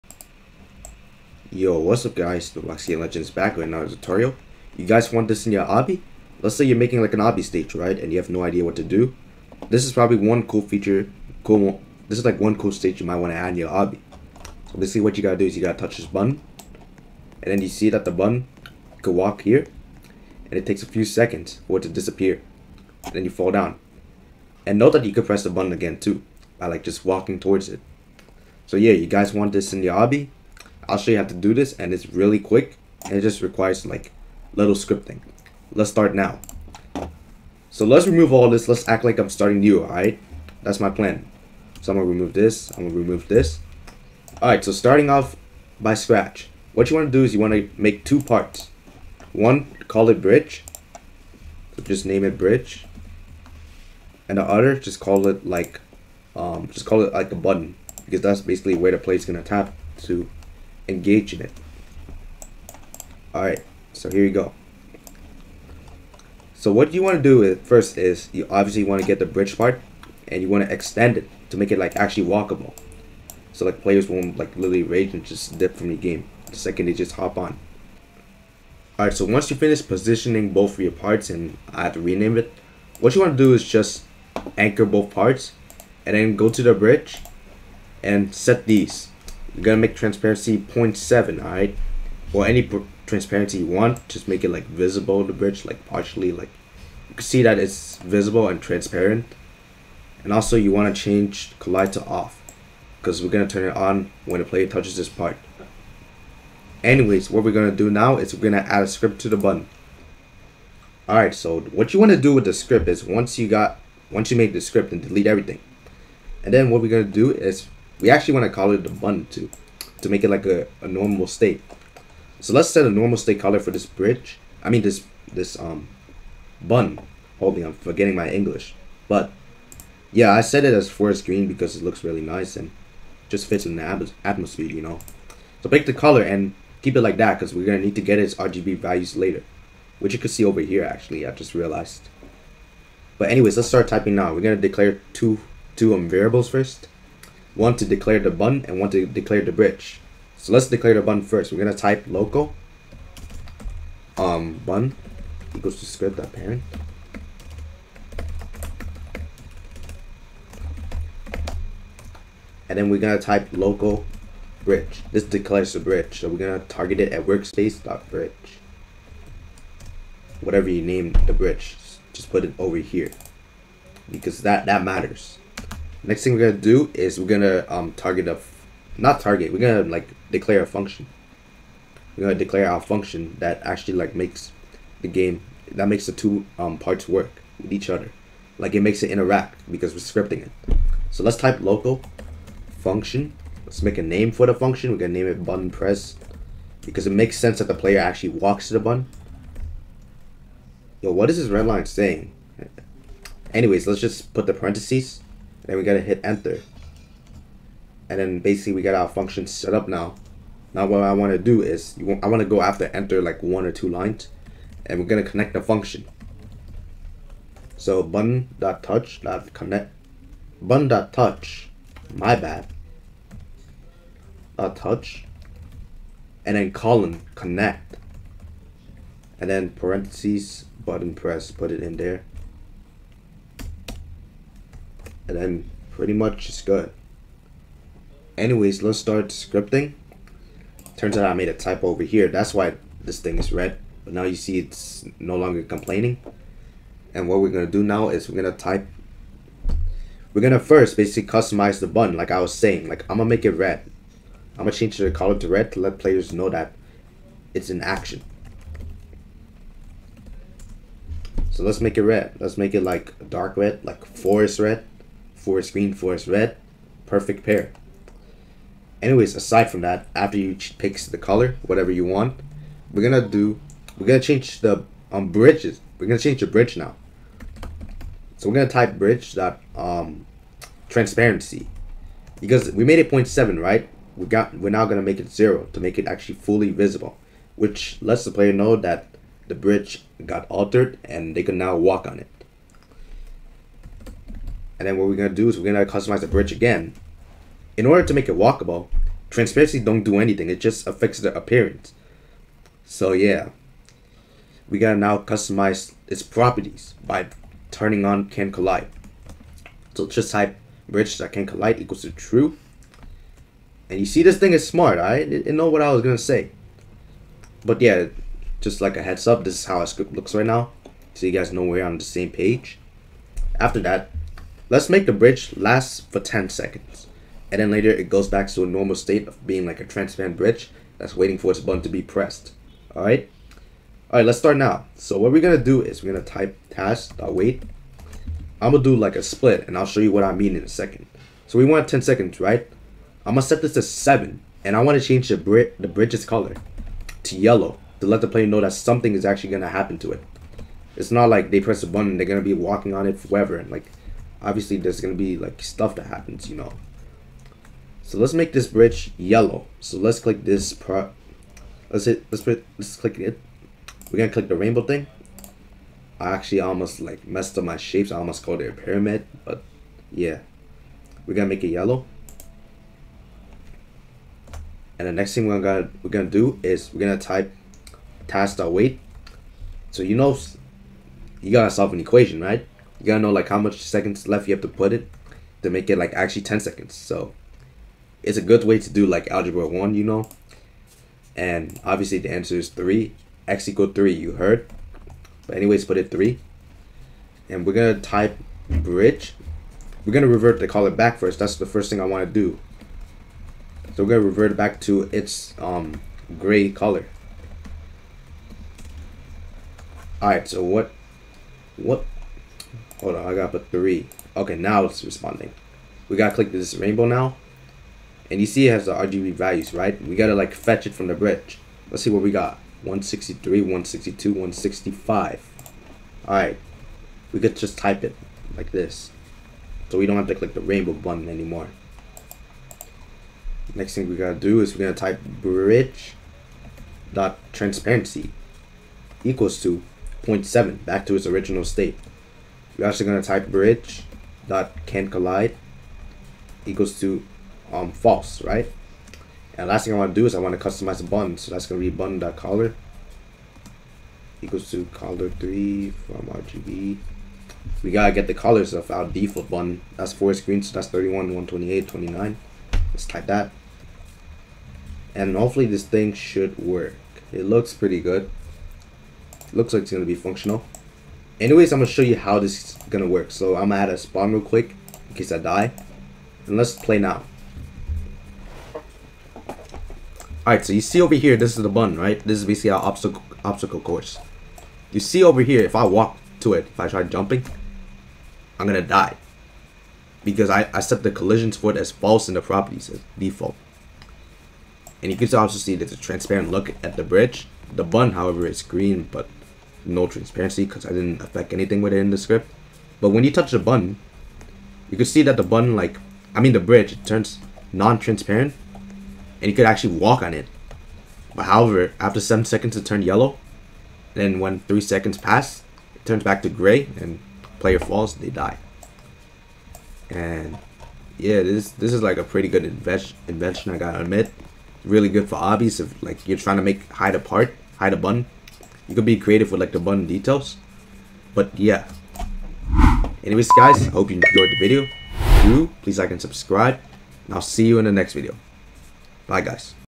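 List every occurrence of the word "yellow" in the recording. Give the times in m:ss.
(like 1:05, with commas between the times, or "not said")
5:47, 5:59, 6:11, 8:33.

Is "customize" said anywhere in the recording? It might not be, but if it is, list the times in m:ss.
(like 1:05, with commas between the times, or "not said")
4:11, 4:55, 5:05, 7:30.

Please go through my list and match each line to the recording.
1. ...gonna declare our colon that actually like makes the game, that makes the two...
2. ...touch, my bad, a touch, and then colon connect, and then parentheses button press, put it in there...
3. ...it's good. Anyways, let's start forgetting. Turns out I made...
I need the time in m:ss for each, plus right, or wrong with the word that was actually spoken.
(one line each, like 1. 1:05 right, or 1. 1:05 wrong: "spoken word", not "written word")
1. 3:02 wrong: "function", not "colon"
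2. 3:41 right
3. 3:56 wrong: "scripting", not "forgetting".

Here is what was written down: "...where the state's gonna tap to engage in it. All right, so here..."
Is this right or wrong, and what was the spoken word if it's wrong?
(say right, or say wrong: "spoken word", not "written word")
wrong: "plate", not "state".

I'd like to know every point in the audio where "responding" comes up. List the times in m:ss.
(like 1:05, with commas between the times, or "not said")
6:55.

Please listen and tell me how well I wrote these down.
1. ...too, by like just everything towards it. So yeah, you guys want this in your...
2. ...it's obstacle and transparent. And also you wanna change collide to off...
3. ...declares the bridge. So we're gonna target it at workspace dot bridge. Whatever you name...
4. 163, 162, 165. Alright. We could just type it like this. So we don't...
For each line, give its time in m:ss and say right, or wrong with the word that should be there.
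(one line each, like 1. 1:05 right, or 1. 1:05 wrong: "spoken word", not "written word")
1. 0:25 wrong: "walking", not "everything"
2. 1:37 wrong: "visible", not "obstacle"
3. 2:45 right
4. 7:02 right.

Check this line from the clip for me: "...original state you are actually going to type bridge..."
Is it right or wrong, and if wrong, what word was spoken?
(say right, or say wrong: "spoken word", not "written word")
right.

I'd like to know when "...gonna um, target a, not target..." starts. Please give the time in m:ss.
2:57.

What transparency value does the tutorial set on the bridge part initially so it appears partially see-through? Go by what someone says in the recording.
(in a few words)
0.7.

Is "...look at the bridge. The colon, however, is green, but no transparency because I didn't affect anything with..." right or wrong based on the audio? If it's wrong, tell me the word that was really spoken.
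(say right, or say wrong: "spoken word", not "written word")
wrong: "button", not "colon".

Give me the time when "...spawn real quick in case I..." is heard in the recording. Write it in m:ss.
7:53.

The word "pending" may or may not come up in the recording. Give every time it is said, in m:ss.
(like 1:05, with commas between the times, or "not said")
not said.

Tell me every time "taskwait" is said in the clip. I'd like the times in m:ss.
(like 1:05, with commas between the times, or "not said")
5:36, 6:18.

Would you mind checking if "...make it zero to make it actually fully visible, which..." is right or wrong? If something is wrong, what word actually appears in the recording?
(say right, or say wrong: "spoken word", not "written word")
right.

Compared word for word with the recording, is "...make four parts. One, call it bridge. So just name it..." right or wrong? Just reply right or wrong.
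wrong.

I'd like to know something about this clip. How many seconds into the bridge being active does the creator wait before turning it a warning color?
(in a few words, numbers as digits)
7.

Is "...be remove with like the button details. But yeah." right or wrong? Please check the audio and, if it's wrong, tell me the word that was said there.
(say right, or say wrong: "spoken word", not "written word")
wrong: "creative", not "remove".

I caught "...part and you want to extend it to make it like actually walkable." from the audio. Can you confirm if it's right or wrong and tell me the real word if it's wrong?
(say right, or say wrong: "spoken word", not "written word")
right.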